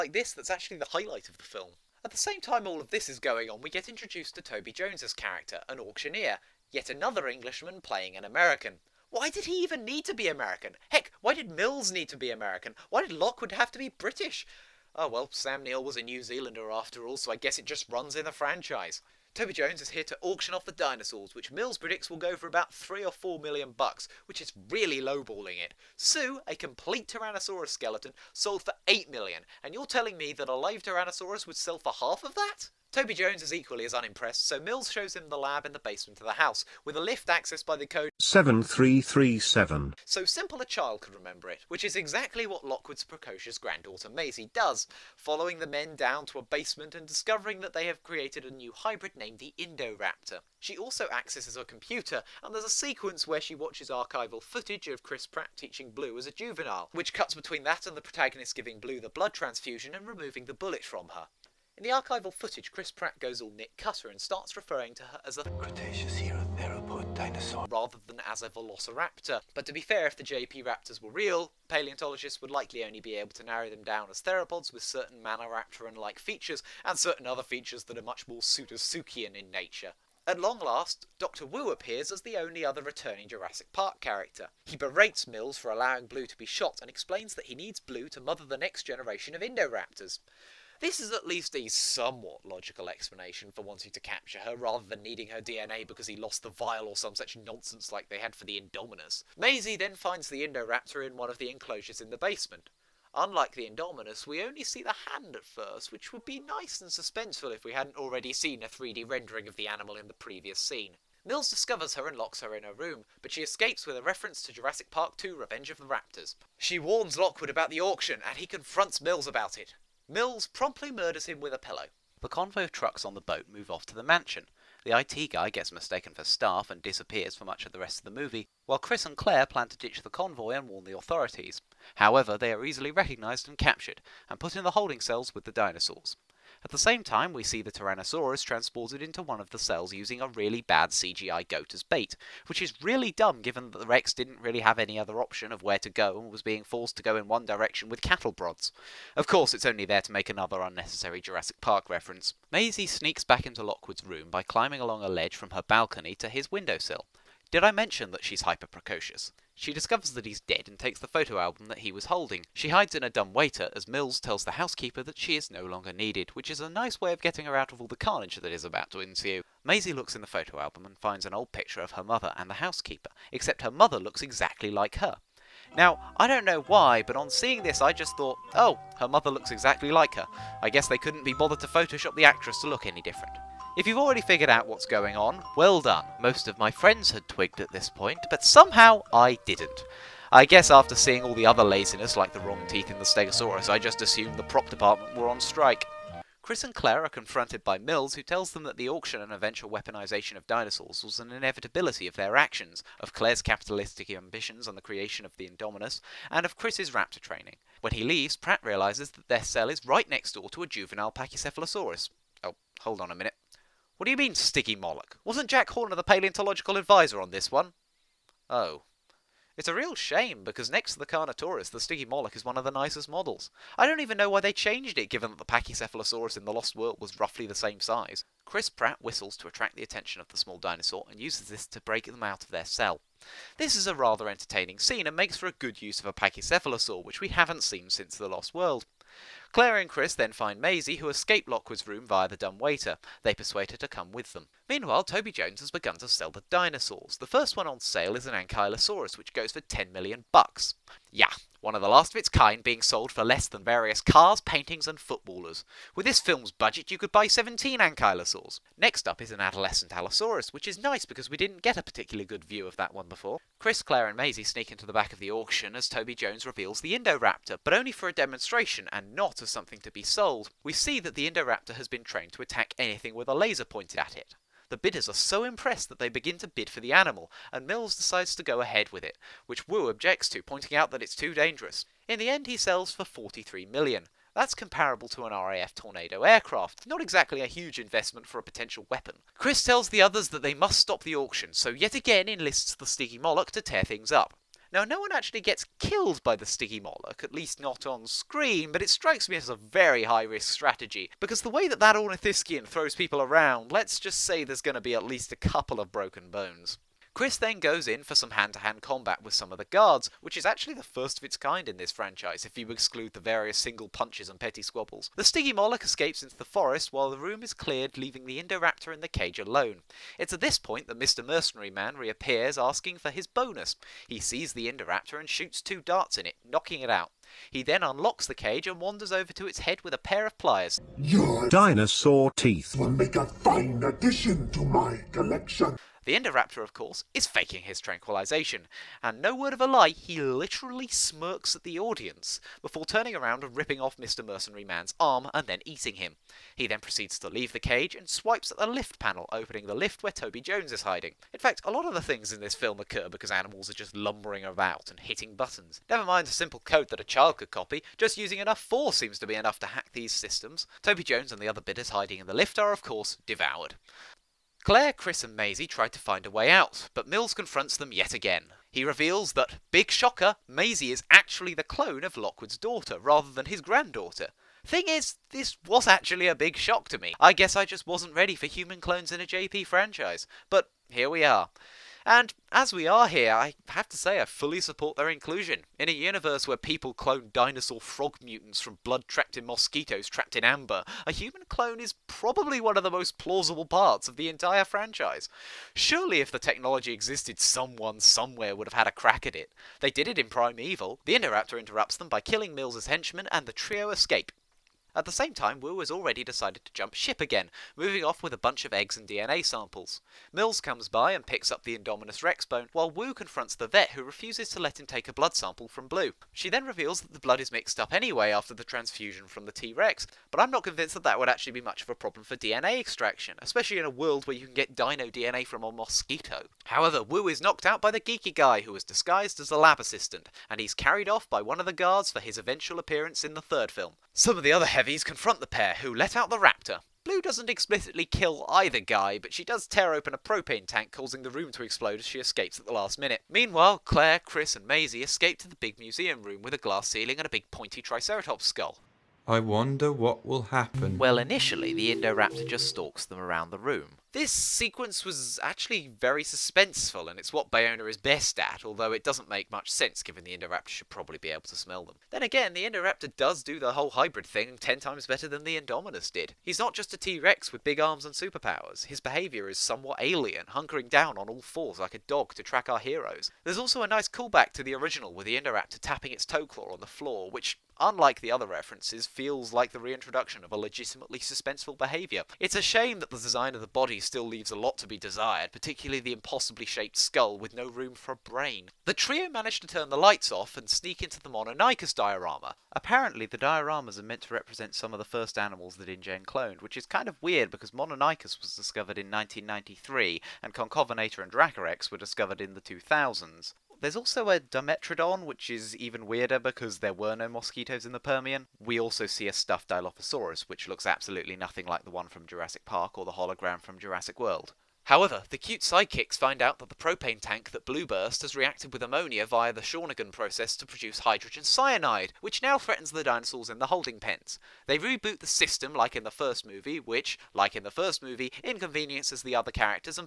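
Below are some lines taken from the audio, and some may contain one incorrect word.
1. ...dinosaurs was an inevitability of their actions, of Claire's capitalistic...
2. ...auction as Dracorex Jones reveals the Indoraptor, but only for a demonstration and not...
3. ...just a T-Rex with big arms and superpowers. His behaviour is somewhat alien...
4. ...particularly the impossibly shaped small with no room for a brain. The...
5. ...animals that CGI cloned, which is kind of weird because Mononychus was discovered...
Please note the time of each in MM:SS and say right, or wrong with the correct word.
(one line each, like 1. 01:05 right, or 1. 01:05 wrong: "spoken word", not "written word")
1. 03:20 right
2. 04:25 wrong: "Toby", not "Dracorex"
3. 07:46 right
4. 08:05 wrong: "skull", not "small"
5. 08:15 wrong: "InGen", not "CGI".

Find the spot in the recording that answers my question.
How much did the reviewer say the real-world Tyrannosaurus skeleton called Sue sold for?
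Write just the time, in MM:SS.
00:28.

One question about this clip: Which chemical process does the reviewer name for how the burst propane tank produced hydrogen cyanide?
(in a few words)
Shawinigan process.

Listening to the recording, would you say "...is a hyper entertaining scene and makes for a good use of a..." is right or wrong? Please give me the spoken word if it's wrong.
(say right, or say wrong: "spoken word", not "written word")
wrong: "rather", not "hyper".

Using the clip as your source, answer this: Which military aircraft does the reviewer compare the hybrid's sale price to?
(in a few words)
RAF Tornado.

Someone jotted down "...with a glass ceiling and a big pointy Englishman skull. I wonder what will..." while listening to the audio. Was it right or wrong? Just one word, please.
wrong.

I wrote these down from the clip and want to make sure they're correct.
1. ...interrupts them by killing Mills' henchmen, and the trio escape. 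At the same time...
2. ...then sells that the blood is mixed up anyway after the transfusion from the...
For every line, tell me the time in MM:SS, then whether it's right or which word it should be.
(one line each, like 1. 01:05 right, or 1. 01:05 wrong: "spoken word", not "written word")
1. 06:41 right
2. 06:56 wrong: "reveals", not "sells".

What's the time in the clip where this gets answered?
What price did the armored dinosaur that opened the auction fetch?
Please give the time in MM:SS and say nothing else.
04:09.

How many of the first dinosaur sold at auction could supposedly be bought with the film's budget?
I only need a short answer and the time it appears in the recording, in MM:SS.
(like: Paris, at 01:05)
17, at 04:17.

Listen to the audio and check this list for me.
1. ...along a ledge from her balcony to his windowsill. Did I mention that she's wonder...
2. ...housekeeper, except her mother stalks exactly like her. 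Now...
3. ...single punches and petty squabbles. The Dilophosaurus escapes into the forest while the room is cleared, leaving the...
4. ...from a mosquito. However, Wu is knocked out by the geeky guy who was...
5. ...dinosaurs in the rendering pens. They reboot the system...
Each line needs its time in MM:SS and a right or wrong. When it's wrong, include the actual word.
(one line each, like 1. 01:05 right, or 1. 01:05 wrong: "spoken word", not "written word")
1. 02:34 wrong: "hyper", not "wonder"
2. 02:52 wrong: "looks", not "stalks"
3. 05:13 wrong: "Moloch", not "Dilophosaurus"
4. 07:05 right
5. 08:43 wrong: "holding", not "rendering".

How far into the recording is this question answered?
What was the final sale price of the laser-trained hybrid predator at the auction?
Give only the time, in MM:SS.
04:43.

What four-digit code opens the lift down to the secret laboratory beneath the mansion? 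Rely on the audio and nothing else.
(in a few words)
7337.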